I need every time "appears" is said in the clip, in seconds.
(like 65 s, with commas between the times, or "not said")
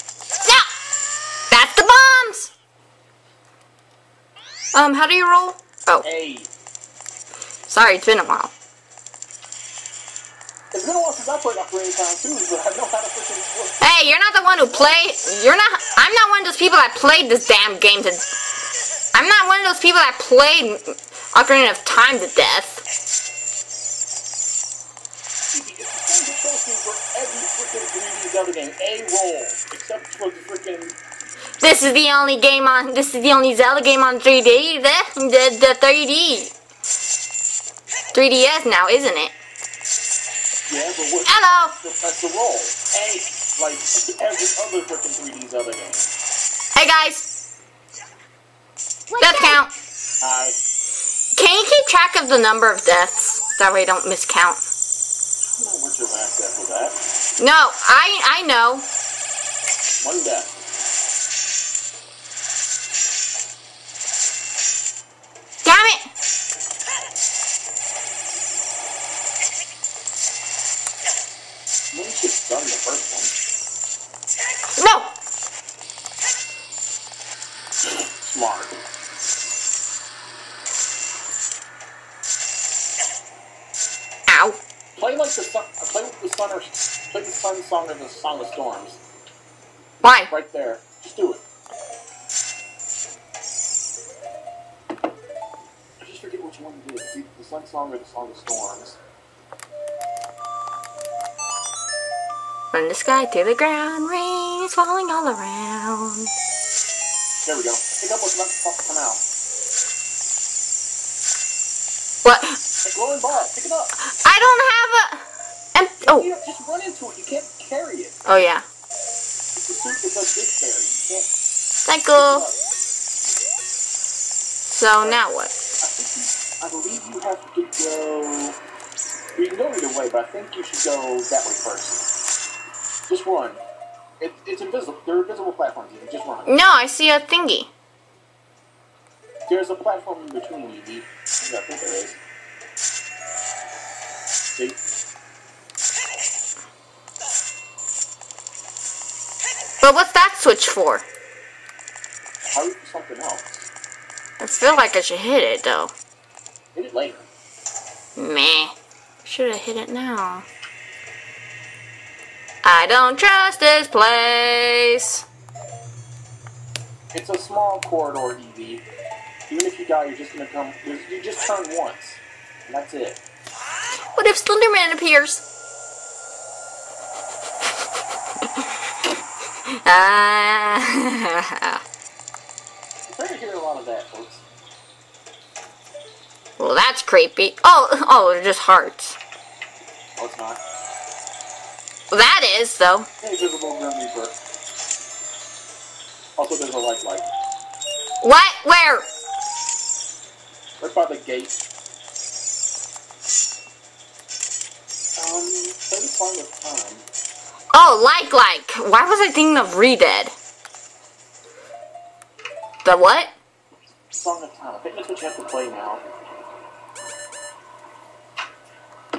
174 s.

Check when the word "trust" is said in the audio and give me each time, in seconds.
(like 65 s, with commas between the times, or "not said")
163 s.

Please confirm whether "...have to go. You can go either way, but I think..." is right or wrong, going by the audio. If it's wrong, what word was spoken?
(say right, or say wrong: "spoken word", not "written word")
right.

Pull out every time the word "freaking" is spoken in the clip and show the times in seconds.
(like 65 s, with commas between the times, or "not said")
44 s.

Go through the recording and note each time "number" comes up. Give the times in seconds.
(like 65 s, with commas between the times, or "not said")
52 s.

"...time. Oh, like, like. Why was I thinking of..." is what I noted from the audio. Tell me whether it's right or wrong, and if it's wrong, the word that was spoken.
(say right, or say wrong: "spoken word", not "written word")
right.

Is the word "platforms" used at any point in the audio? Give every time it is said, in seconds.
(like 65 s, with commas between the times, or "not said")
135 s, 139 s.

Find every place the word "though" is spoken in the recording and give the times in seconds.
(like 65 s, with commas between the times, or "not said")
155 s, 192 s.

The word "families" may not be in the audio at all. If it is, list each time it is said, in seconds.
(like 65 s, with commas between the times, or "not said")
not said.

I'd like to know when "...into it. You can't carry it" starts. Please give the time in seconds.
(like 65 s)
116 s.